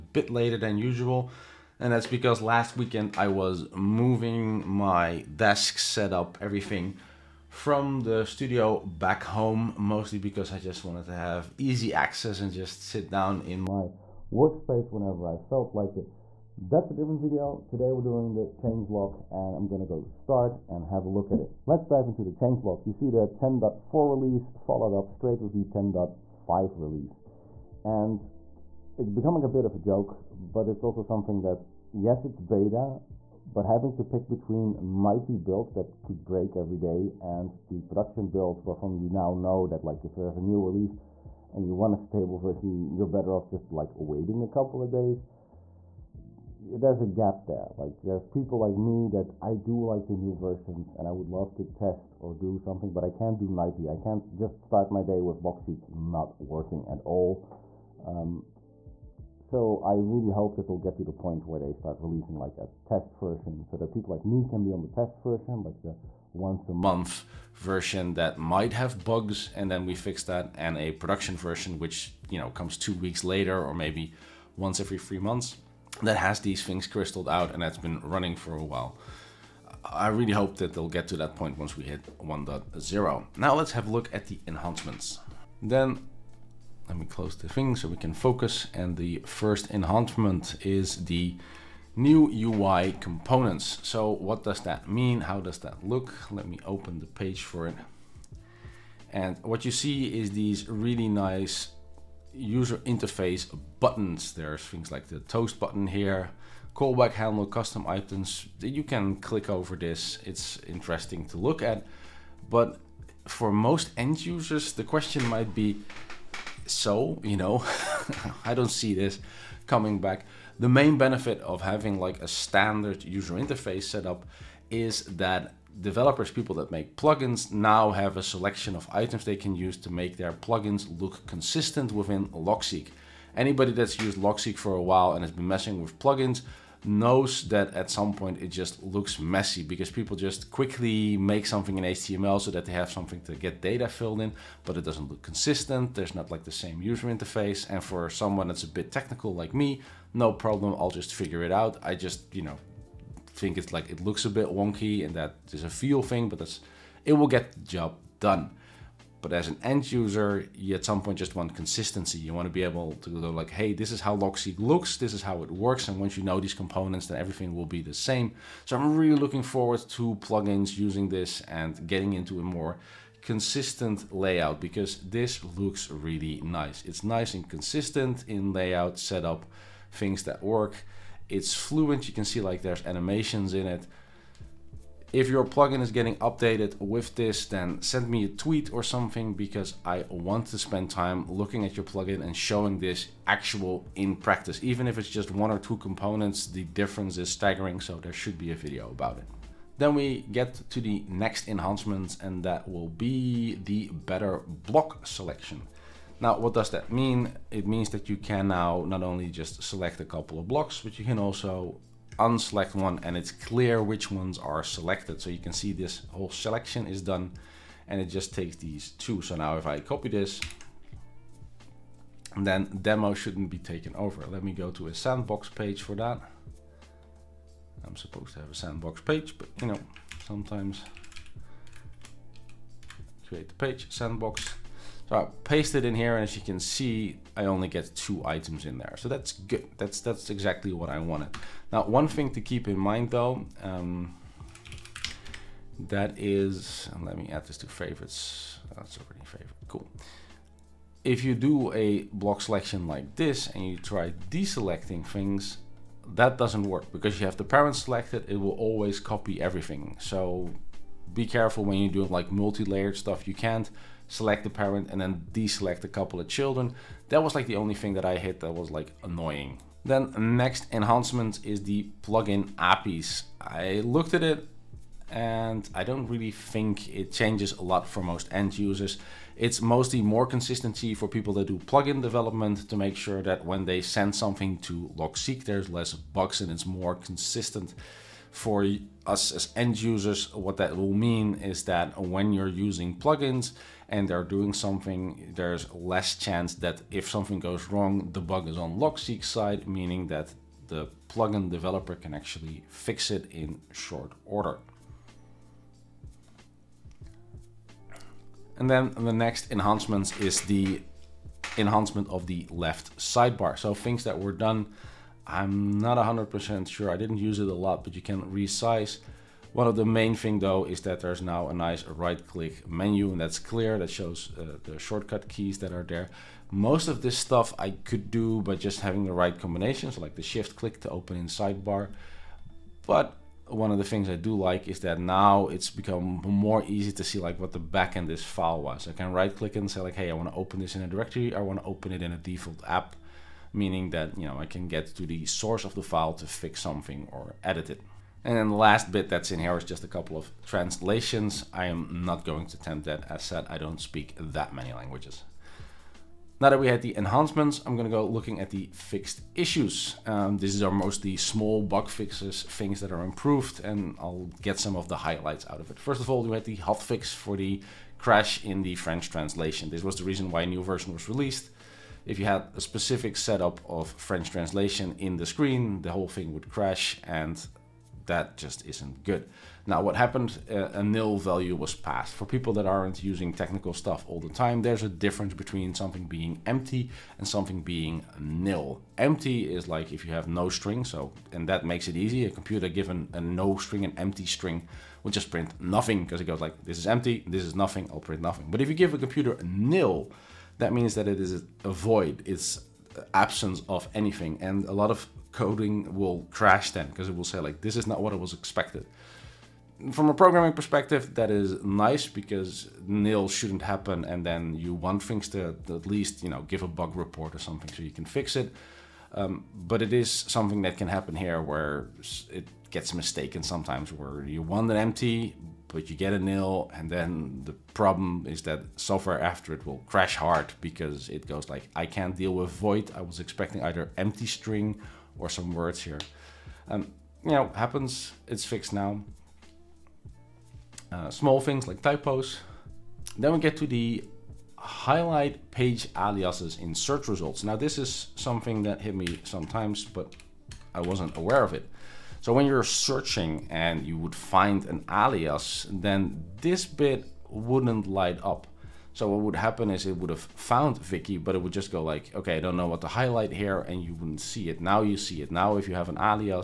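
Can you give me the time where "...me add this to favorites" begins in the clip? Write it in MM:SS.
04:07.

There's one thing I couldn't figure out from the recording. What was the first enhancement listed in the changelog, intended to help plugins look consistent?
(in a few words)
New UI components.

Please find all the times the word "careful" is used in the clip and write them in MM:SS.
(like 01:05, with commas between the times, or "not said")
04:21.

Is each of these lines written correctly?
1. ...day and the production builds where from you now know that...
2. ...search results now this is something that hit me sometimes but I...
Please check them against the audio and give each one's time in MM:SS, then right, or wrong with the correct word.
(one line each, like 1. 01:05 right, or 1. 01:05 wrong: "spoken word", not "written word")
1. 00:36 right
2. 07:26 right.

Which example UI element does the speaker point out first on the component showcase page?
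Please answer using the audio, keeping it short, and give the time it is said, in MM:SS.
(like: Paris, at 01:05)
Toast button, at 01:45.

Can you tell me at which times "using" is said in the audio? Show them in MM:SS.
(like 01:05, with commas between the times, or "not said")
02:50, 04:52, 06:23.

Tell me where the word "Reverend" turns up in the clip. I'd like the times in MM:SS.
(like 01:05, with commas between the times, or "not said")
not said.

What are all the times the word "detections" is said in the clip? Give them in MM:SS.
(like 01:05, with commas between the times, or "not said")
not said.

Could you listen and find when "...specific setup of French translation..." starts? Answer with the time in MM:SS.
06:12.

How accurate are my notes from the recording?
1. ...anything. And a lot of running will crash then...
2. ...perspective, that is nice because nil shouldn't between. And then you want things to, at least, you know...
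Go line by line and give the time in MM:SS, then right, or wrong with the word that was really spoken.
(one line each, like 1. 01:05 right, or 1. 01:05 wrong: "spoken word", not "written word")
1. 06:43 wrong: "coding", not "running"
2. 06:50 wrong: "happen", not "between".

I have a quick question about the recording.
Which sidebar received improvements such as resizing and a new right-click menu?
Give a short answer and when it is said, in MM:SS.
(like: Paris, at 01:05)
Left sidebar, at 05:12.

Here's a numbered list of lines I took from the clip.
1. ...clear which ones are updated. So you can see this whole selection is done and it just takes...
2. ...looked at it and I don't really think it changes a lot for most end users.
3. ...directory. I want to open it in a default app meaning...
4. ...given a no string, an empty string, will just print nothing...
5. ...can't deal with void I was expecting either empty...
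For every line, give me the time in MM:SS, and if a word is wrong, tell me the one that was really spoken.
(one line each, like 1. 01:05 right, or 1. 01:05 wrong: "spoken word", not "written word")
1. 03:33 wrong: "selected", not "updated"
2. 04:33 right
3. 05:40 right
4. 06:32 right
5. 07:11 right.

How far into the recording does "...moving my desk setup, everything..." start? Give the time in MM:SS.
00:03.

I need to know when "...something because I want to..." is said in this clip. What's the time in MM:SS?
03:08.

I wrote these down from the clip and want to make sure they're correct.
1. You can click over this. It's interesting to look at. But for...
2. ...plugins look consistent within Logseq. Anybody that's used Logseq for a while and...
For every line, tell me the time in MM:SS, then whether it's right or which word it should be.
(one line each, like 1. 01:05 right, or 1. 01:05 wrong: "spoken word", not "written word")
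1. 01:48 right
2. 02:10 right.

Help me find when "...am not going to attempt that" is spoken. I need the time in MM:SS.
05:51.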